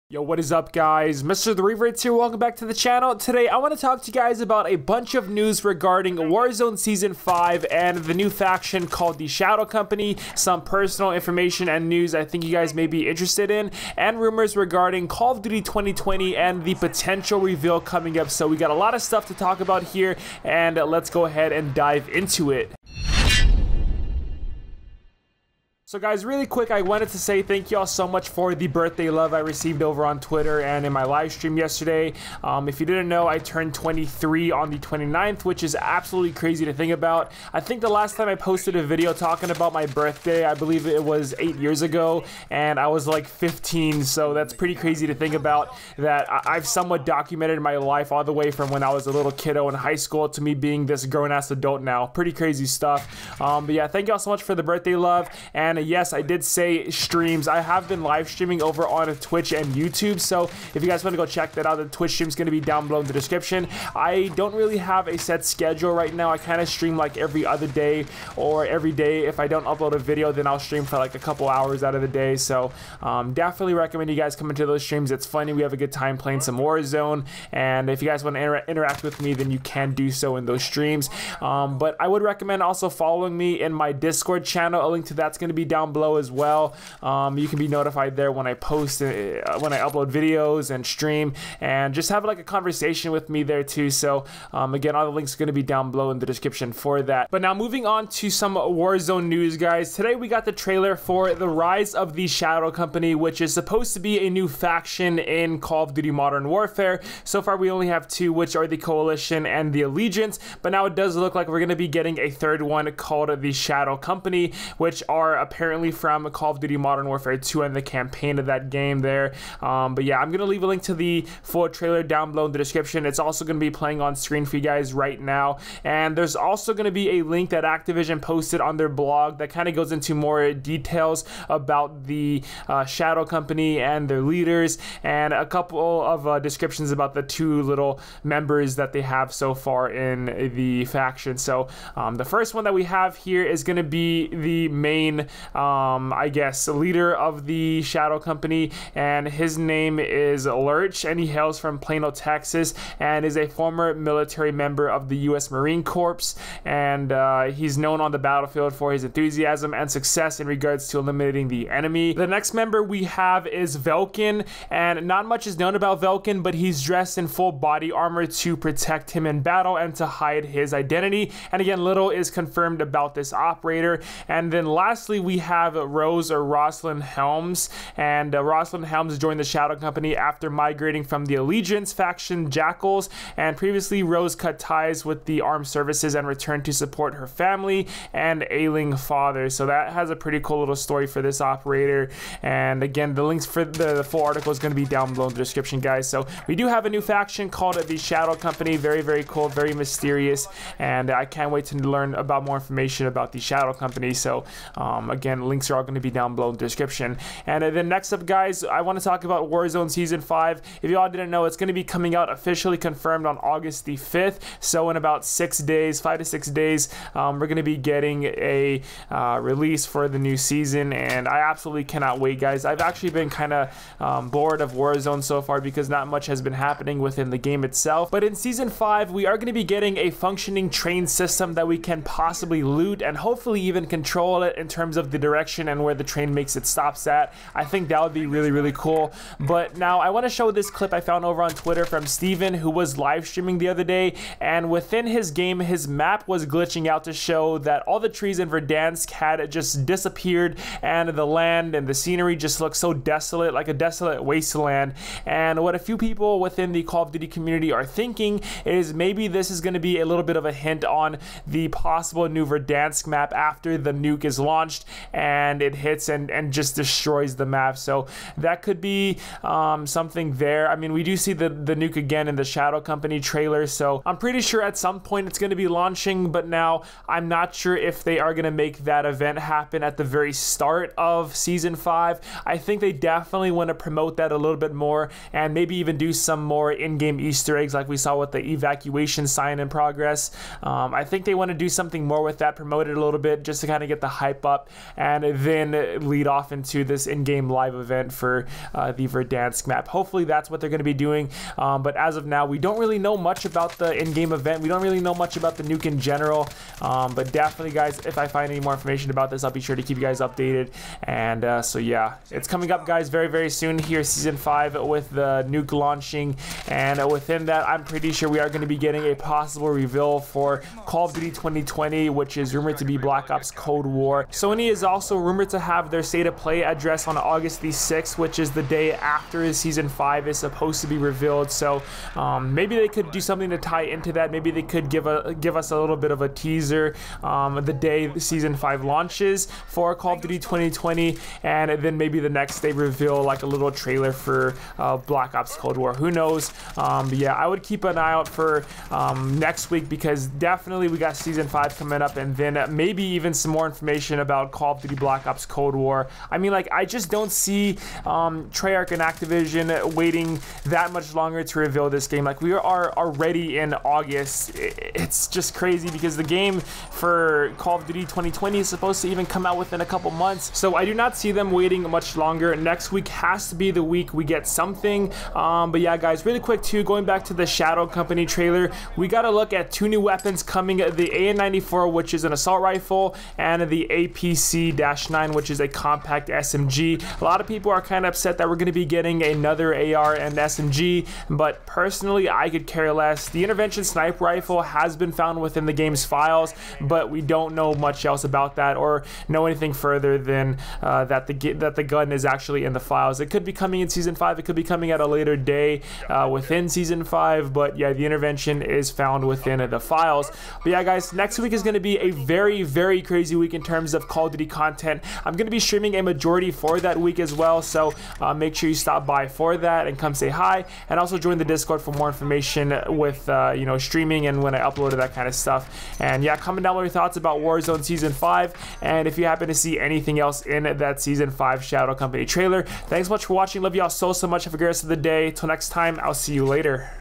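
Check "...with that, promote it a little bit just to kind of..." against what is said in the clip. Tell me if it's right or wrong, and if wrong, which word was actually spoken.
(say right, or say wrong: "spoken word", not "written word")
right.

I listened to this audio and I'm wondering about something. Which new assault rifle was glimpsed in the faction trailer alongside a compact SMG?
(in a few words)
AN-94.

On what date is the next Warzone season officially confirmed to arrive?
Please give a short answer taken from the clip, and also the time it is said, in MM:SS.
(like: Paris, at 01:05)
August 5th, at 03:33.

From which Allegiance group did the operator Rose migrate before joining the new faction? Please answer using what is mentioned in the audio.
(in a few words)
Jackals.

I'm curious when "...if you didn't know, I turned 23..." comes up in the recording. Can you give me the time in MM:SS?
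00:32.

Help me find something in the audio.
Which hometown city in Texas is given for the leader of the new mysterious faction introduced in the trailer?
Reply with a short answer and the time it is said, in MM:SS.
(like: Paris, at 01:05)
Plano, at 02:31.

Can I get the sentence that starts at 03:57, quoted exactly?
I think that would be really, really cool.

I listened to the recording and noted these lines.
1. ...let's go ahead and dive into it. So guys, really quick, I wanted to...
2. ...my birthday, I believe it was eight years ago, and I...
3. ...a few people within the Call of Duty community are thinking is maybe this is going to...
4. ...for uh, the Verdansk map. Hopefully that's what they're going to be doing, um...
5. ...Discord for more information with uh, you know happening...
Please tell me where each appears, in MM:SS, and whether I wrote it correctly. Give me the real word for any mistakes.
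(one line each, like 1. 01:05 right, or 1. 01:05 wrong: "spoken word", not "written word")
1. 00:20 right
2. 00:39 right
3. 04:15 right
4. 04:58 right
5. 07:01 wrong: "streaming", not "happening".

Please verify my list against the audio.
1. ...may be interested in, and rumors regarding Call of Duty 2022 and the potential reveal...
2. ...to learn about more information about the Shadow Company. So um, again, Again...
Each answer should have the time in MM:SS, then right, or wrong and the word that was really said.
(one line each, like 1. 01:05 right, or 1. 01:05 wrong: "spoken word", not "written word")
1. 00:12 wrong: "2020", not "2022"
2. 03:21 right.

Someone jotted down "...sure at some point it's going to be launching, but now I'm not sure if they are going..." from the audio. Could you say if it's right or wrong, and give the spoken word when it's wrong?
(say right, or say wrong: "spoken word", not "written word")
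right.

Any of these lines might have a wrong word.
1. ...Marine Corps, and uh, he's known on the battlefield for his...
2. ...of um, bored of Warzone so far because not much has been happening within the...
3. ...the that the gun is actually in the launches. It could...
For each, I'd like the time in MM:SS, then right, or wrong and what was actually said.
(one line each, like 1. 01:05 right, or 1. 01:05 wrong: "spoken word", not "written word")
1. 02:35 right
2. 03:43 right
3. 06:41 wrong: "files", not "launches".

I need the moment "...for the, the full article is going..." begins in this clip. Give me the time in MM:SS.
03:13.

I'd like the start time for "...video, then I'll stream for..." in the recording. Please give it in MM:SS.
01:09.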